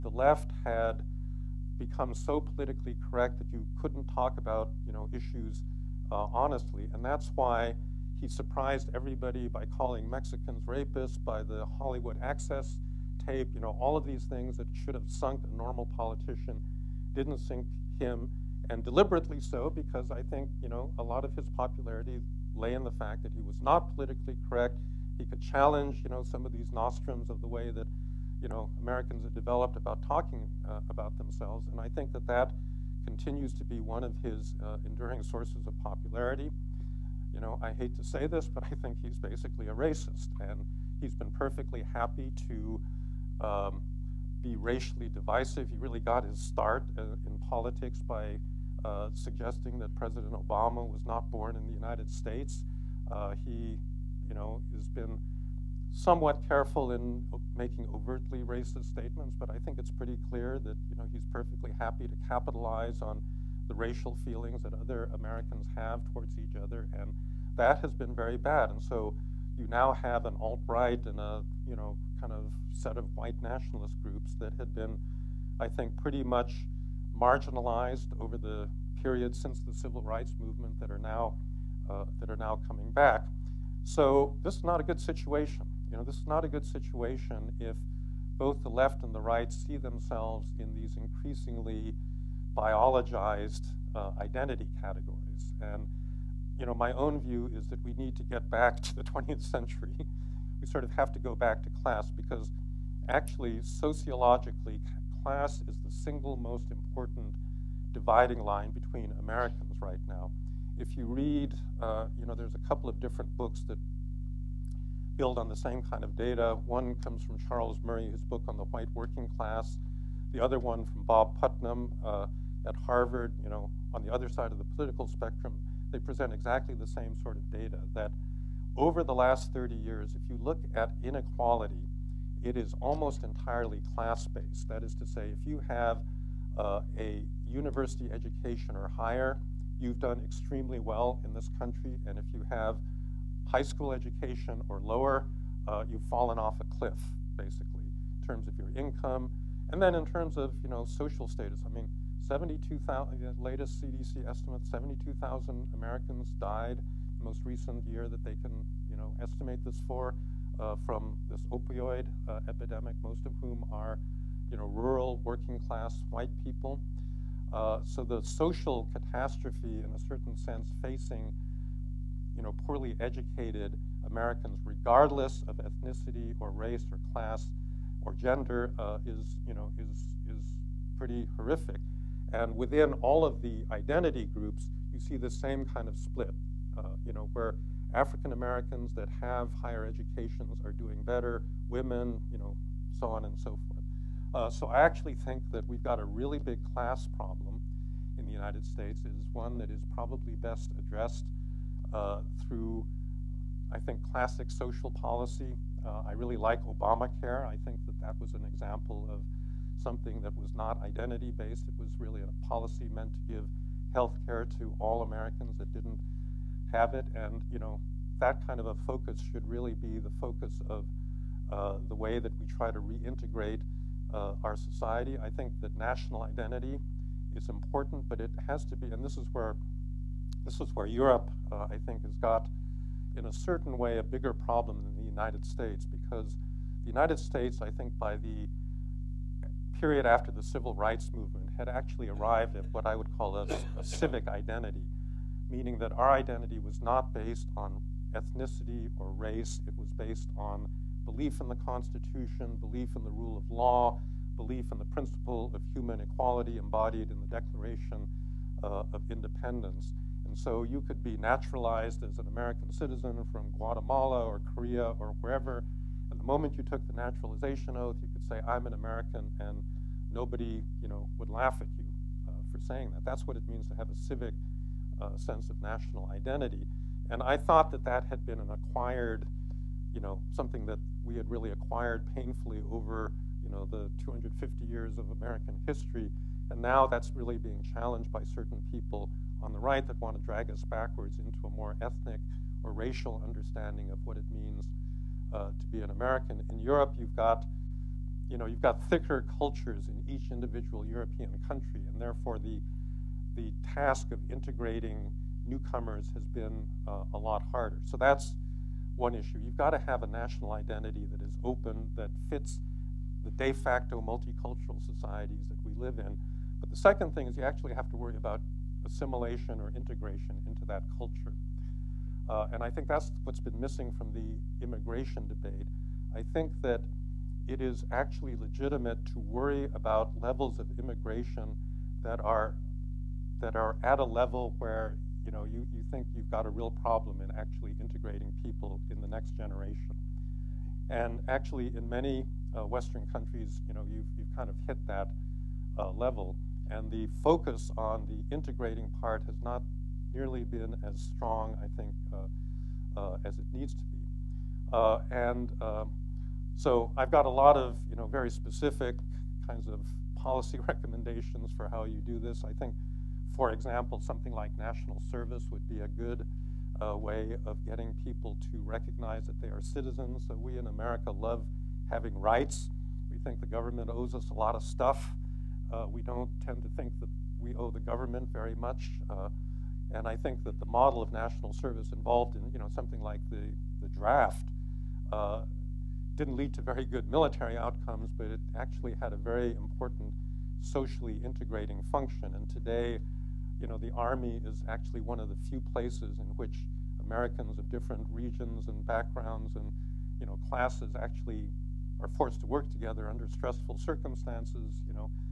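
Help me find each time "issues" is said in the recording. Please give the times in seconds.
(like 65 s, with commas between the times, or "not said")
5 s, 309 s.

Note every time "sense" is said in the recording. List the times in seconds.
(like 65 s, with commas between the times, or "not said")
170 s, 275 s.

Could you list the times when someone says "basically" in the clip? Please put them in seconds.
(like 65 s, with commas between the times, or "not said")
39 s, 147 s.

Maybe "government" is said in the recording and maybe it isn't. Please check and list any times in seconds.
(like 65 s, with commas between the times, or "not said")
373 s, 377 s.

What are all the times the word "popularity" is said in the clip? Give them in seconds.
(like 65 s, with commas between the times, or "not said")
21 s, 35 s.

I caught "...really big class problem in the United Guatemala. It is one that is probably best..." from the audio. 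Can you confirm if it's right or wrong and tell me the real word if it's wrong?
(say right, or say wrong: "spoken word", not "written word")
wrong: "States", not "Guatemala".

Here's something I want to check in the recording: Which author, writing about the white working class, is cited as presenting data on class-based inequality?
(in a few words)
Charles Murray.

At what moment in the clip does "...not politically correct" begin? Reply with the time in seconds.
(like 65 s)
23 s.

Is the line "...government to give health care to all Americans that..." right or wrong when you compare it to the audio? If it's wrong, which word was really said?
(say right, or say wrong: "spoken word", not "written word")
wrong: "meant", not "government".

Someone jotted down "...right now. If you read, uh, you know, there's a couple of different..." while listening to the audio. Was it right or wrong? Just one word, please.
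right.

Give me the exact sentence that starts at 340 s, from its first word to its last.
And actually, in many uh, Western countries, you know, you've, you've kind of hit that uh, level.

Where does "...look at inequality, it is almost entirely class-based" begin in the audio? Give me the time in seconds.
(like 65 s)
130 s.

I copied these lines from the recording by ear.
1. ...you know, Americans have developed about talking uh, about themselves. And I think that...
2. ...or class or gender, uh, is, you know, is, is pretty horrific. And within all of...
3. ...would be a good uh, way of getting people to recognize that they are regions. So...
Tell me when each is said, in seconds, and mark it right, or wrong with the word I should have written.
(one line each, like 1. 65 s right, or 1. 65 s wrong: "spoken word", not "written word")
1. 28 s right
2. 176 s right
3. 365 s wrong: "citizens", not "regions".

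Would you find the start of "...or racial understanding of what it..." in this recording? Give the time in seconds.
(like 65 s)
292 s.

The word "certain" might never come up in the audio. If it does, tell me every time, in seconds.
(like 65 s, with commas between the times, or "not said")
169 s, 233 s, 288 s.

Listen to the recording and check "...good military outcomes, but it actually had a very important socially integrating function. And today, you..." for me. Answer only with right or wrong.
right.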